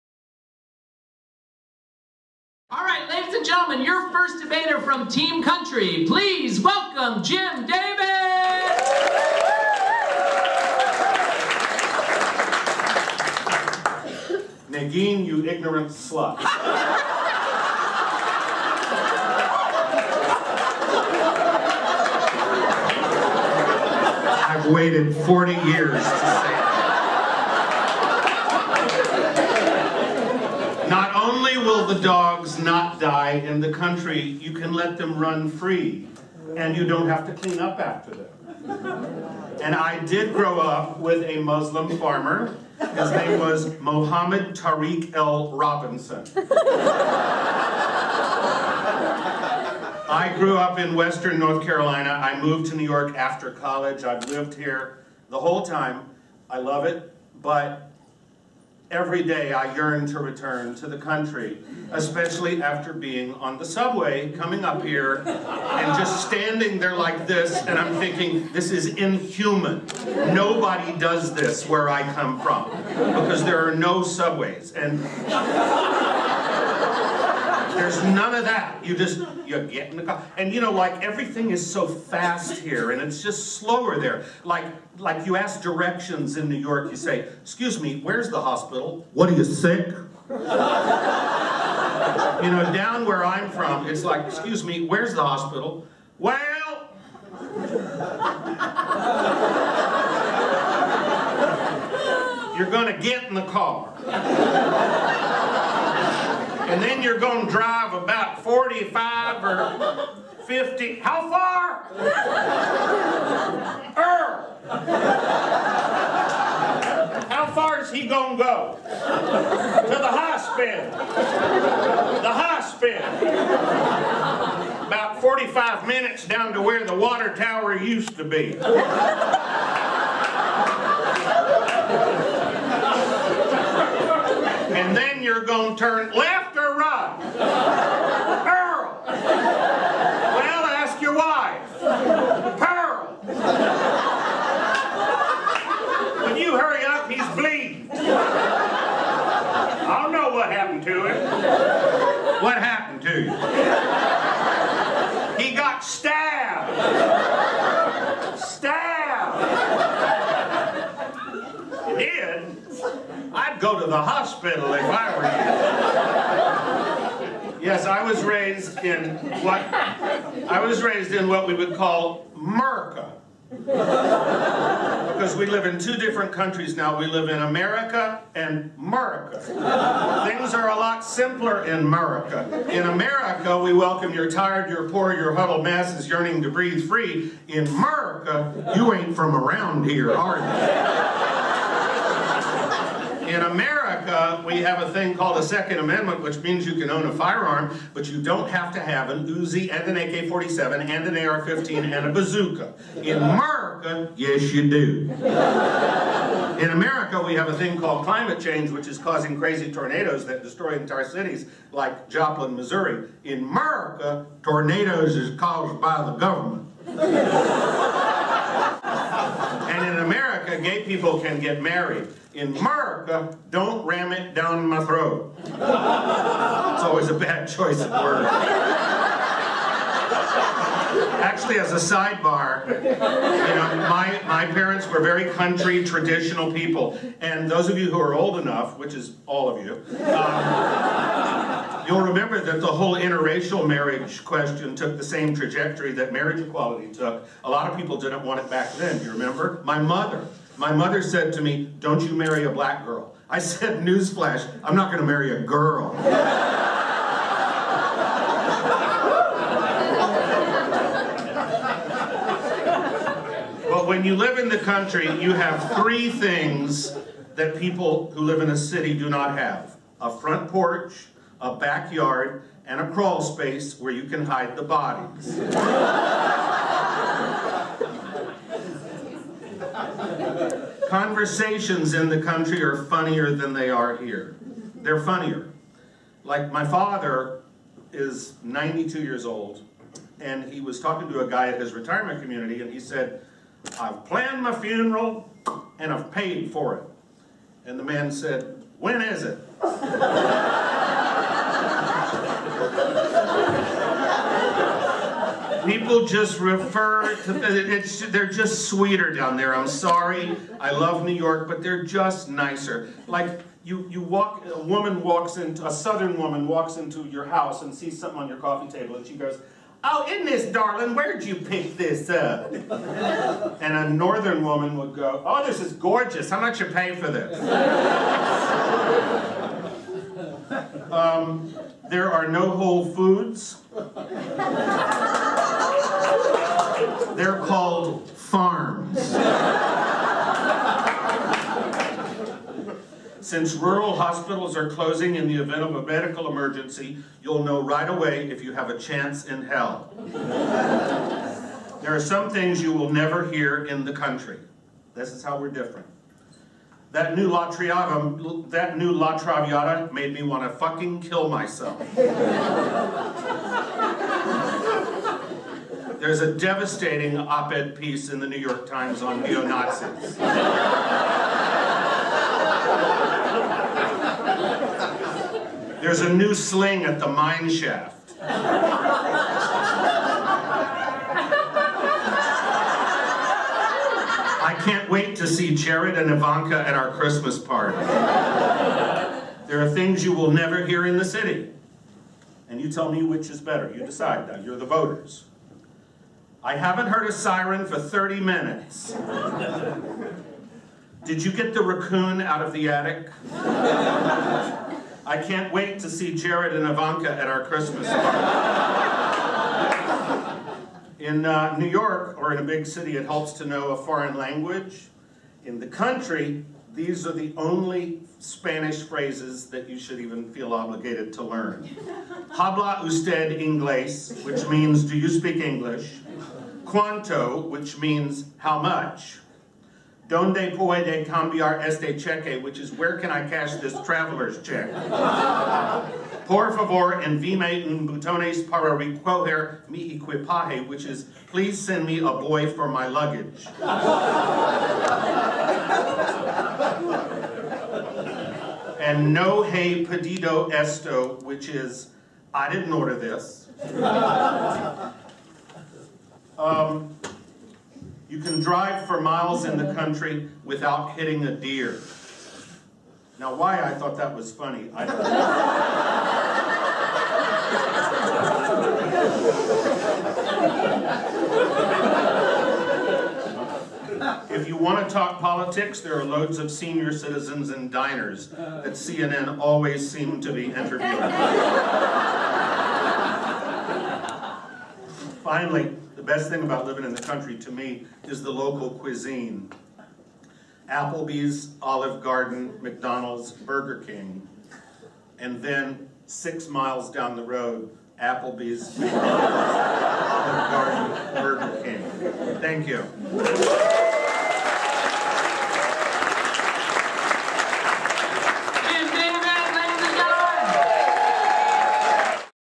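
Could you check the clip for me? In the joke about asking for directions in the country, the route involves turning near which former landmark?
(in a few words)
the water tower.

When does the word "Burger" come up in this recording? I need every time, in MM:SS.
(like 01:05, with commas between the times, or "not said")
08:13, 08:21.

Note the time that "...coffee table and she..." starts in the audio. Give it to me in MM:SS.
05:18.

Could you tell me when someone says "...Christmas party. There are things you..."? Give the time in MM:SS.
06:26.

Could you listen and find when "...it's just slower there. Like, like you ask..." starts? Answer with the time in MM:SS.
01:23.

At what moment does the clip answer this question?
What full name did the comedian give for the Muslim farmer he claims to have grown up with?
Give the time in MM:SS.
00:43.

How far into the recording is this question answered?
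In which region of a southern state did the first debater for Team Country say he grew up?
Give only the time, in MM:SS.
00:50.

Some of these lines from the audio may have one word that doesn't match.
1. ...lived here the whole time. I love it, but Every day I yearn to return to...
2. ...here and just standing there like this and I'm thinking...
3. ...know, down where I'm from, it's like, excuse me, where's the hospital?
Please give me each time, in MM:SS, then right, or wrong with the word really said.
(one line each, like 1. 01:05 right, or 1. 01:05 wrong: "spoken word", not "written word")
1. 00:54 right
2. 01:04 right
3. 01:32 right.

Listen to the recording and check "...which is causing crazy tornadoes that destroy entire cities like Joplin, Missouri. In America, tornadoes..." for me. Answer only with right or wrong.
right.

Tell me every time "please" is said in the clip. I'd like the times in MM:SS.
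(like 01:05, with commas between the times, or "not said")
00:06, 07:21.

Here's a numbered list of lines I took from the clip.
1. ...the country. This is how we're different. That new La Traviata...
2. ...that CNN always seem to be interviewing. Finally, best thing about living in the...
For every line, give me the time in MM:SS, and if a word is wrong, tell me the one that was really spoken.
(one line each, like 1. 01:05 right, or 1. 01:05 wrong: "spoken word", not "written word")
1. 05:53 right
2. 07:58 right.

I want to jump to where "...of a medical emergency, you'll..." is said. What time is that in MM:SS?
05:45.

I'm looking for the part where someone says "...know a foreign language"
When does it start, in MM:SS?
06:53.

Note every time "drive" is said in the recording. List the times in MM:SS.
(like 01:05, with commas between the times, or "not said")
01:47, 07:38.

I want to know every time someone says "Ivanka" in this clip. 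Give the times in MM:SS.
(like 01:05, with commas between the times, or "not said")
06:26, 06:46.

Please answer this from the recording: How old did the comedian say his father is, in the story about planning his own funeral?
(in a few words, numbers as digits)
92.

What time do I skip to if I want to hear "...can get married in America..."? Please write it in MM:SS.
03:41.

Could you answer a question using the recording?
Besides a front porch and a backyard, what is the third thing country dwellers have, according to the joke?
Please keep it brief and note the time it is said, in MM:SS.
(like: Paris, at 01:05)
a crawl space, at 04:32.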